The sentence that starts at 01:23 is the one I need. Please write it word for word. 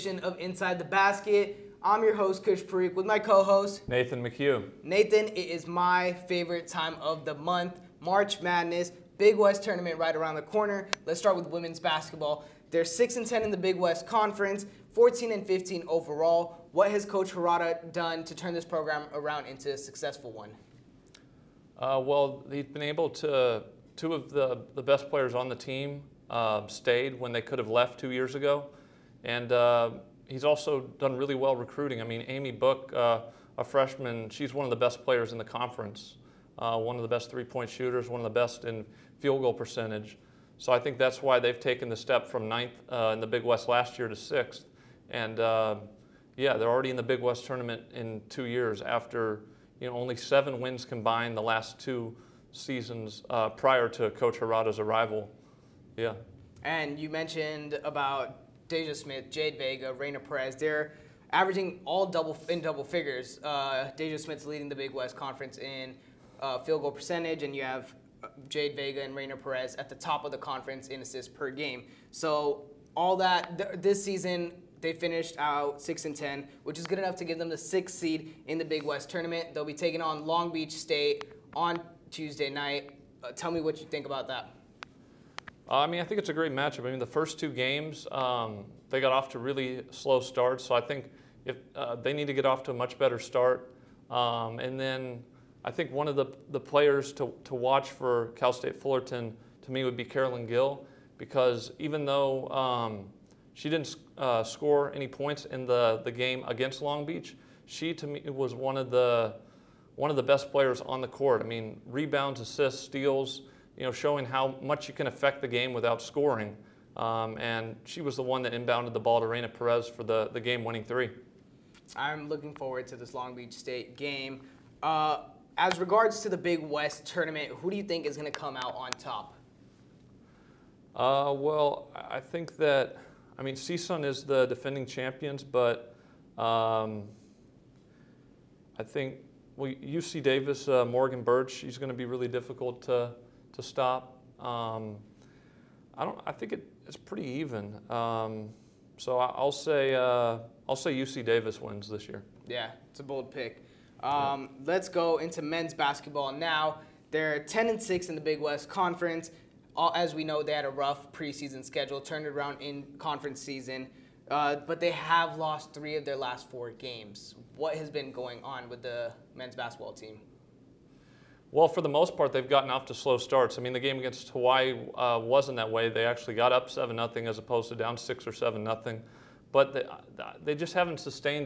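Uh, tell me what you think about that.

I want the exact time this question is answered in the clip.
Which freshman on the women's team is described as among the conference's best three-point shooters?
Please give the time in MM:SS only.
00:32.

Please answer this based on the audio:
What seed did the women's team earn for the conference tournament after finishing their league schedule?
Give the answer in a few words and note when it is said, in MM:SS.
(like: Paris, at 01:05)
6th, at 01:17.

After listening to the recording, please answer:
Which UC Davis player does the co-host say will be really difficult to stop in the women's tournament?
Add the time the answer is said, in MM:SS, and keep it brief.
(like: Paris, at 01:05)
Morgan Bertsch, at 02:20.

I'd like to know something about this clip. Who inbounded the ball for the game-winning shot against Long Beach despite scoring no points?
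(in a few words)
Carolyn Gill.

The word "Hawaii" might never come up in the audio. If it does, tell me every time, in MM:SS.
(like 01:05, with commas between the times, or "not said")
02:54.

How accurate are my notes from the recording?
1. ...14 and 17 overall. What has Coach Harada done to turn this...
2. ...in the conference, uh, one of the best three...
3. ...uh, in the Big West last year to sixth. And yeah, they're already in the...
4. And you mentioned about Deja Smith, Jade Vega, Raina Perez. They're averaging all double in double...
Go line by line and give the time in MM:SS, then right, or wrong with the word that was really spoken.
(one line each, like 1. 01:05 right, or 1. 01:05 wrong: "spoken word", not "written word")
1. 00:14 wrong: "15", not "17"
2. 00:35 right
3. 00:42 right
4. 00:56 right.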